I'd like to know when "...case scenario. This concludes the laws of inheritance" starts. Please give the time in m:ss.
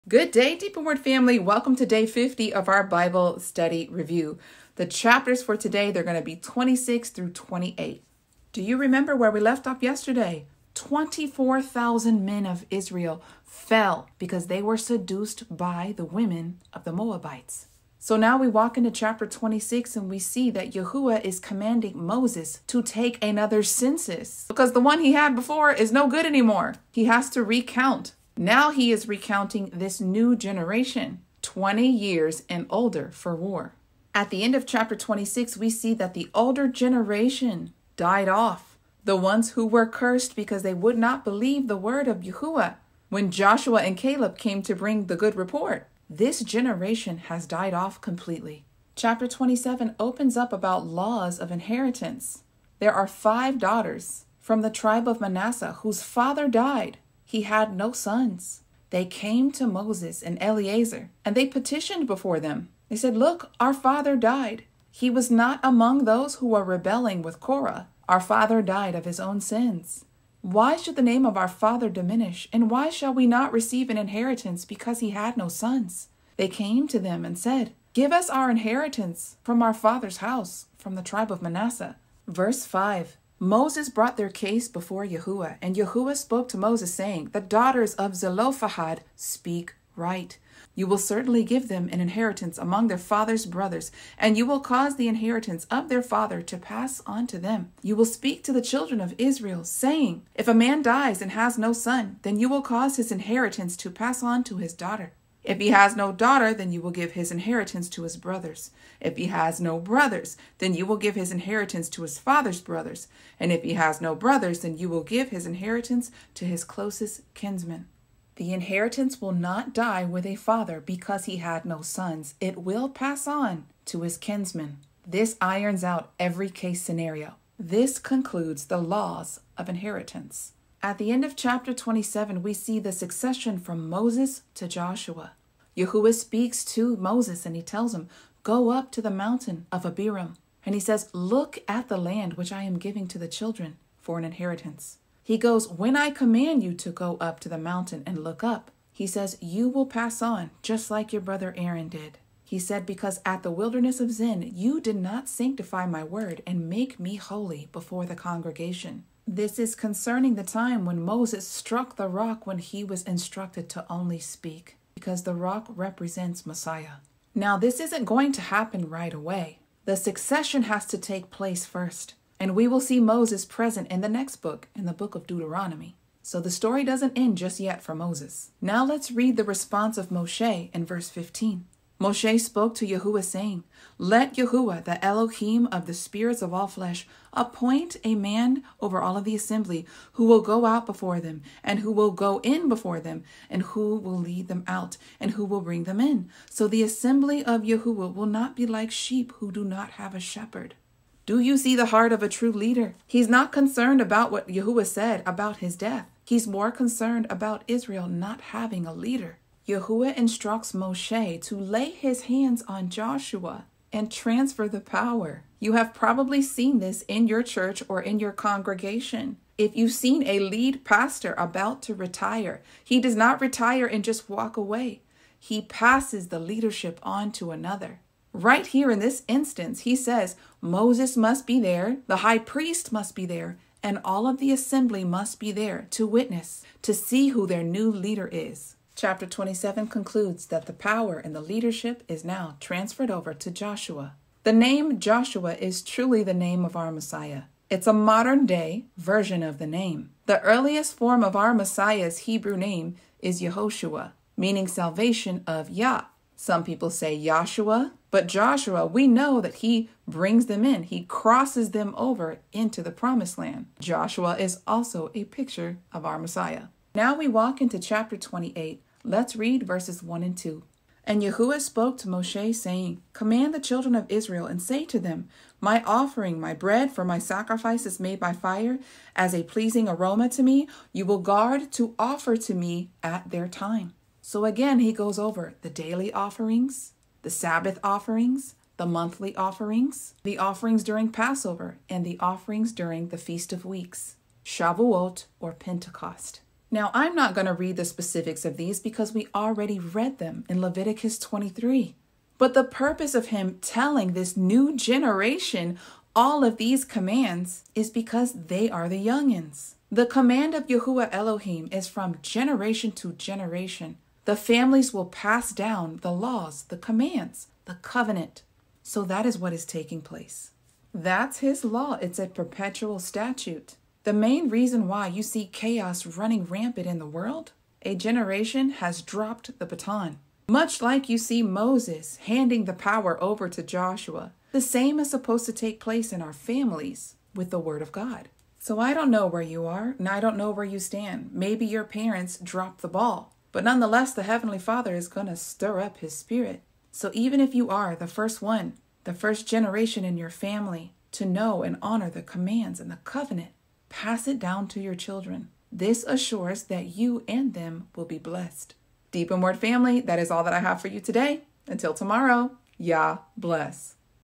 2:06.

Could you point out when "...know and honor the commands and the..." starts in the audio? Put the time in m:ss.
5:51.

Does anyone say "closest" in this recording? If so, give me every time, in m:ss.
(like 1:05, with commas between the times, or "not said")
1:56.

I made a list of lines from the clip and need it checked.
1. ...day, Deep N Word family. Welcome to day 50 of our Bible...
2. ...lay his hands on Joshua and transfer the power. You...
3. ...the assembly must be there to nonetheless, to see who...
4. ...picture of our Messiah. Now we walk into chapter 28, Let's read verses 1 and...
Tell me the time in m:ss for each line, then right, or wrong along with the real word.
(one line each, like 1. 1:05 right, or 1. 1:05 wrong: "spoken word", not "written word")
1. 0:00 right
2. 3:31 right
3. 3:54 wrong: "witness", not "nonetheless"
4. 4:25 right.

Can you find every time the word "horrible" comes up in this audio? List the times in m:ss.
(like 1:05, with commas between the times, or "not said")
not said.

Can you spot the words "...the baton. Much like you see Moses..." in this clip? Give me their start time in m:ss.
5:29.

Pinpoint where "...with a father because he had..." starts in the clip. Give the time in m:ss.
2:00.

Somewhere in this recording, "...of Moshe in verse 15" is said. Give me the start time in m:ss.
2:59.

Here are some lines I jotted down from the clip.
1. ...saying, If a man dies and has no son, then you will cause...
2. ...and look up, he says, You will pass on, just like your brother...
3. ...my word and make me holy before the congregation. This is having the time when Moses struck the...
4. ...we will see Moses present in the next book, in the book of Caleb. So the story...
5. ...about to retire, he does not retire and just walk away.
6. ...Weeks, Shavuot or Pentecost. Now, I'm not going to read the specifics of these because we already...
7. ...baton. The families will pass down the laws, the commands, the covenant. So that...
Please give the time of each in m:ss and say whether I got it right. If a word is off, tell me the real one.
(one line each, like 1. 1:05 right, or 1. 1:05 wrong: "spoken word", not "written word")
1. 1:39 right
2. 2:28 right
3. 2:35 wrong: "concerning", not "having"
4. 2:52 wrong: "Deuteronomy", not "Caleb"
5. 3:41 right
6. 4:53 right
7. 5:13 wrong: "generation", not "baton".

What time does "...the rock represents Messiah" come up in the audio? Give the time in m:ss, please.
2:45.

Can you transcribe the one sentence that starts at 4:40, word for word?
You will guard to offer to me at their time.